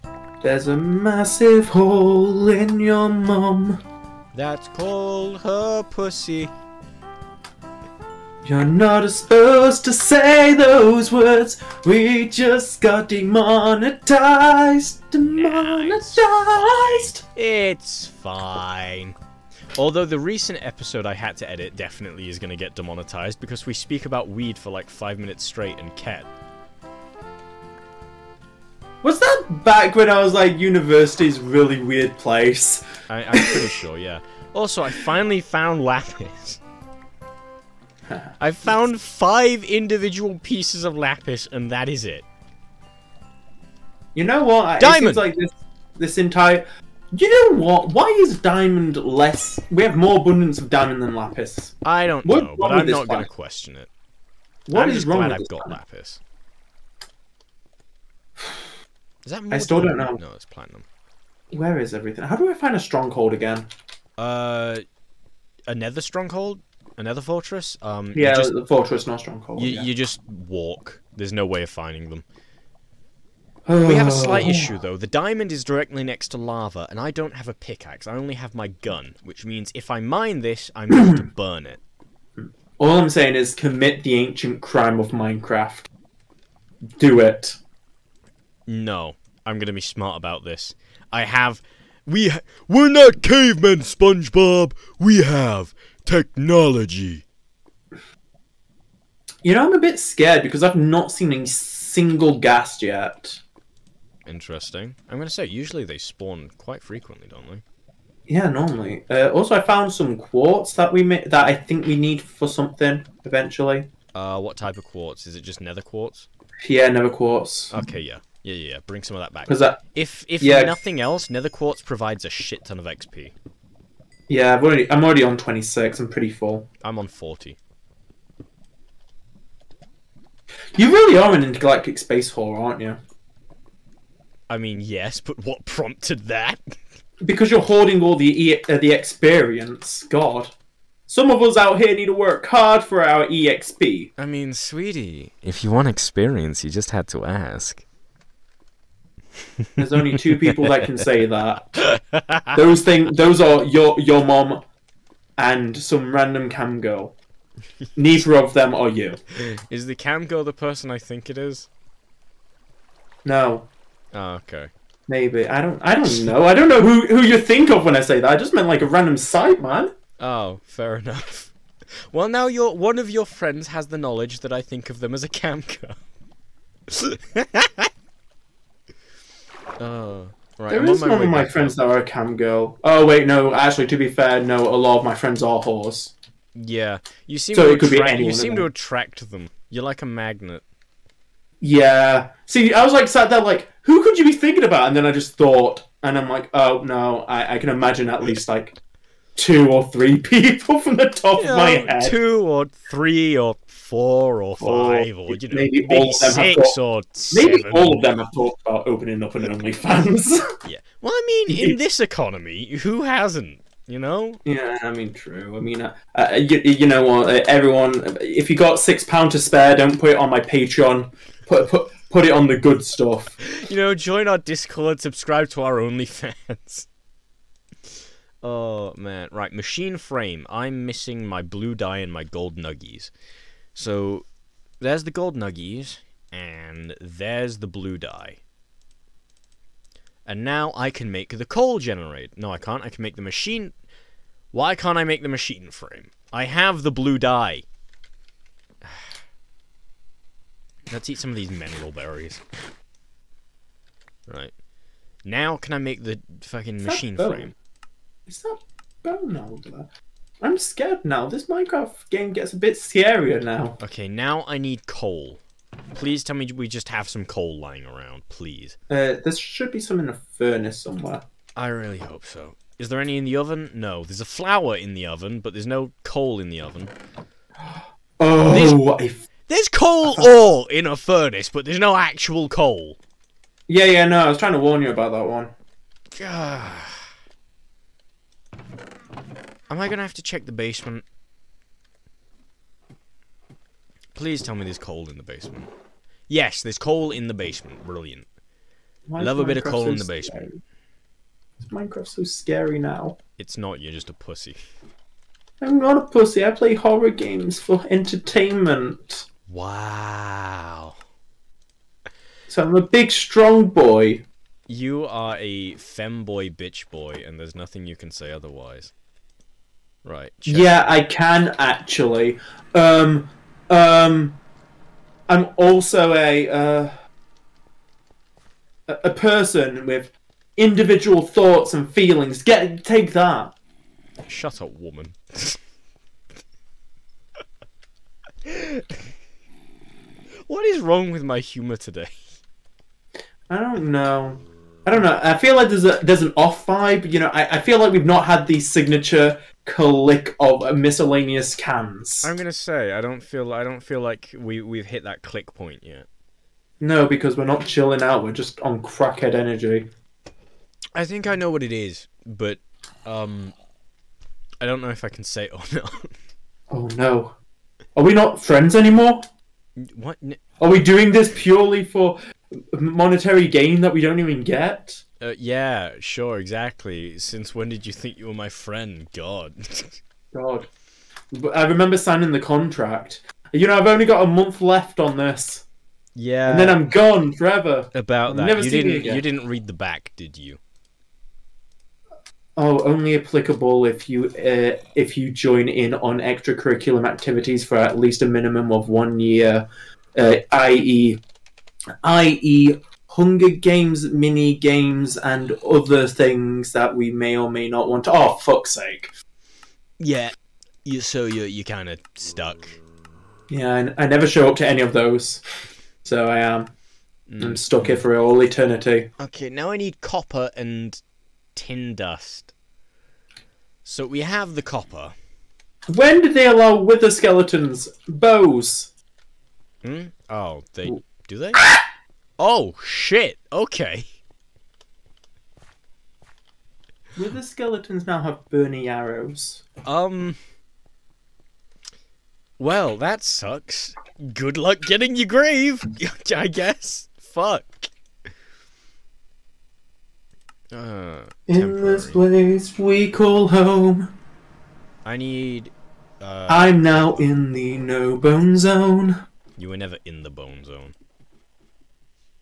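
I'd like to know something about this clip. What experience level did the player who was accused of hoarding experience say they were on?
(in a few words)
40.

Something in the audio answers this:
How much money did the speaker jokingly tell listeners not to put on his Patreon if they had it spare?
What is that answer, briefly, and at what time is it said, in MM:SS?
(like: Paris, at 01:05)
6 pounds, at 03:38.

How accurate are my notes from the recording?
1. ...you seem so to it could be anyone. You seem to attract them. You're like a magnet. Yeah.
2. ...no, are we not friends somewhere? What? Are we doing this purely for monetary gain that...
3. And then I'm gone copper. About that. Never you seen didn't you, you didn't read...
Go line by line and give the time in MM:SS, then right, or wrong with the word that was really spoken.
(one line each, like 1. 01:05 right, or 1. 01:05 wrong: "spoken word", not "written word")
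1. 03:07 right
2. 06:06 wrong: "anymore", not "somewhere"
3. 06:26 wrong: "forever", not "copper".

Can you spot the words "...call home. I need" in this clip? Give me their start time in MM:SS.
07:33.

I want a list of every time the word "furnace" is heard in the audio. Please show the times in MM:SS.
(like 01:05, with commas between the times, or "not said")
04:30, 04:40.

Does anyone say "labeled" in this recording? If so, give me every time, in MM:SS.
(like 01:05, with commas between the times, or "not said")
not said.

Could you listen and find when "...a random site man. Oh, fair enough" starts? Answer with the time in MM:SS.
02:48.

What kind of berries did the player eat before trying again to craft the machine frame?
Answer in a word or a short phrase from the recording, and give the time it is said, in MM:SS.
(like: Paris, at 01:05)
mineral berries, at 04:11.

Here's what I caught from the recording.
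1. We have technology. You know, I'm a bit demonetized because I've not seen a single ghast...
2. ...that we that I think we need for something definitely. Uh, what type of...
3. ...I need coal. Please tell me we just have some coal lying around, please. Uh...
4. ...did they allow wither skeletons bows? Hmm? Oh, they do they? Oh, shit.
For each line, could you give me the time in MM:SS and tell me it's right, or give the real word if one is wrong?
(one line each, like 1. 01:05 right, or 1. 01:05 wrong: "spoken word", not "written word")
1. 01:34 wrong: "scared", not "demonetized"
2. 01:50 wrong: "eventually", not "definitely"
3. 04:24 right
4. 07:06 right.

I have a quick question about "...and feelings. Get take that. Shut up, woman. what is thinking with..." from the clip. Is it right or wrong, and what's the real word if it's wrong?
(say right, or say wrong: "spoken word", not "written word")
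wrong: "wrong", not "thinking".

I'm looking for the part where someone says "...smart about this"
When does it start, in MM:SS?
01:29.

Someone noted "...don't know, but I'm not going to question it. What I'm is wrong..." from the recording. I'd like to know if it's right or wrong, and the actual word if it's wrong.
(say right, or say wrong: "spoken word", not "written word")
right.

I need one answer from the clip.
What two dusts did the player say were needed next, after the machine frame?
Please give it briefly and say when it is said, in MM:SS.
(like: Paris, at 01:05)
copper and tin, at 07:00.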